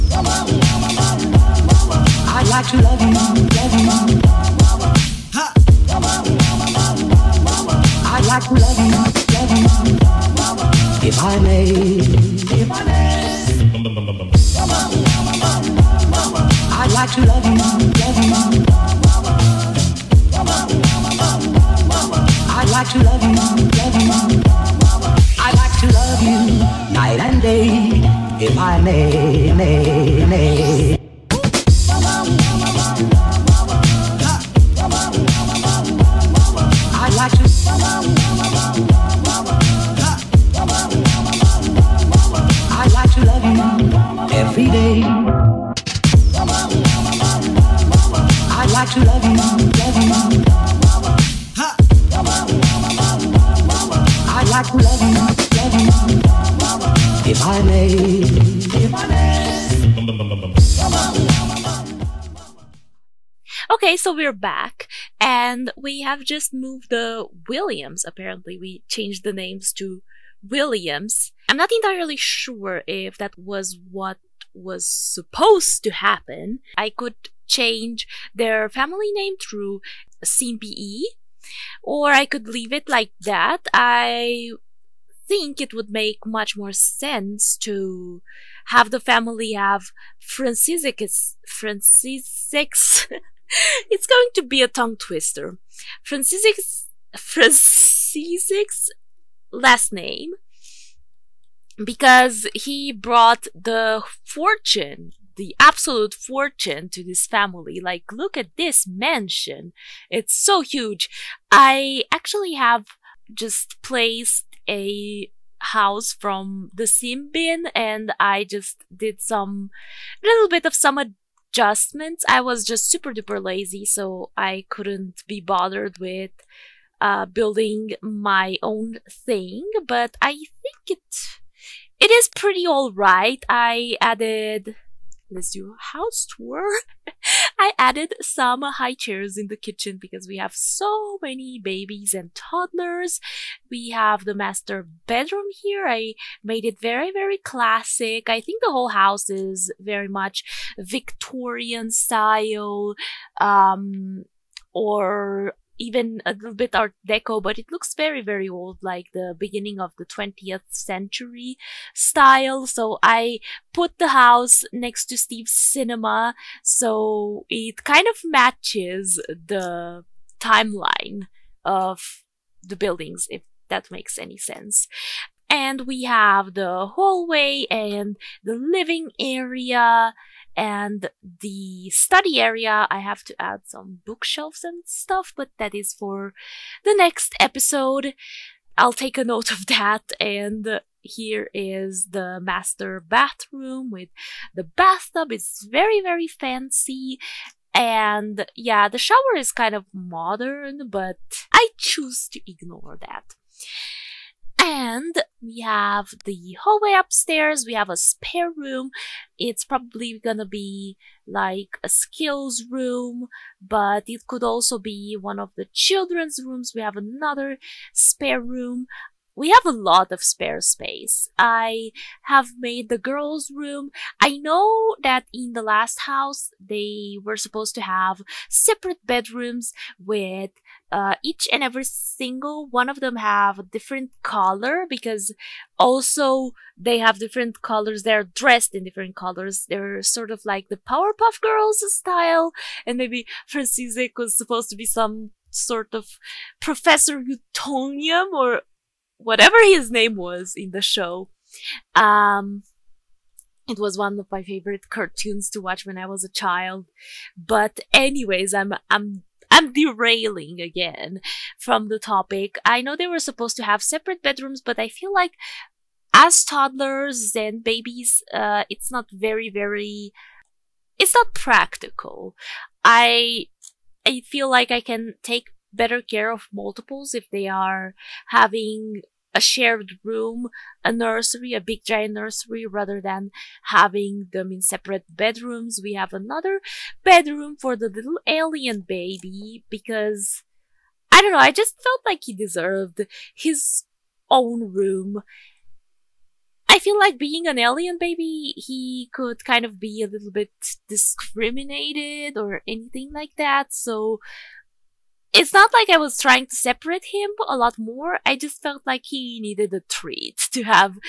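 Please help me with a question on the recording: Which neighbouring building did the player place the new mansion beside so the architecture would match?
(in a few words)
Steve's cinema.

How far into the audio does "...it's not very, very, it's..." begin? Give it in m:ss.
4:28.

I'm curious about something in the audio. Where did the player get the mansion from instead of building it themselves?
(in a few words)
the sim bin.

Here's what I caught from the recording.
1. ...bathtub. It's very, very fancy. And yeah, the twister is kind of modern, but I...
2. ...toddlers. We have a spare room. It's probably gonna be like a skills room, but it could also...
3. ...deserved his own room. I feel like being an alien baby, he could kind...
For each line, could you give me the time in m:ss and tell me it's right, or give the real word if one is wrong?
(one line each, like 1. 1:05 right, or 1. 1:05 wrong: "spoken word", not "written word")
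1. 3:14 wrong: "shower", not "twister"
2. 3:26 wrong: "upstairs", not "toddlers"
3. 4:52 right.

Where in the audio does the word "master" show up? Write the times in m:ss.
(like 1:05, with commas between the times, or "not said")
2:24, 3:12.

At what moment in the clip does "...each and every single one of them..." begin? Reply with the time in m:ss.
3:51.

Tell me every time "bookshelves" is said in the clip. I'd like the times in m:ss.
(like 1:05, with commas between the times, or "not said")
3:04.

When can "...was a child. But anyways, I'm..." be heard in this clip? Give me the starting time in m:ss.
4:16.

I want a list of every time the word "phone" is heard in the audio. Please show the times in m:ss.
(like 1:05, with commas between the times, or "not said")
not said.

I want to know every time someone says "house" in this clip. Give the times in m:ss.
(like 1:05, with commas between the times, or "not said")
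1:55, 2:15, 2:28, 2:44, 3:46.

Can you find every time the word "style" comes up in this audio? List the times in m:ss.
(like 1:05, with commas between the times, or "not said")
2:31, 2:41, 4:01.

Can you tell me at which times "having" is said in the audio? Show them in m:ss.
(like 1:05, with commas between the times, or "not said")
4:38, 4:43.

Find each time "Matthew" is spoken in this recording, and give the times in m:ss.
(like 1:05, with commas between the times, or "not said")
not said.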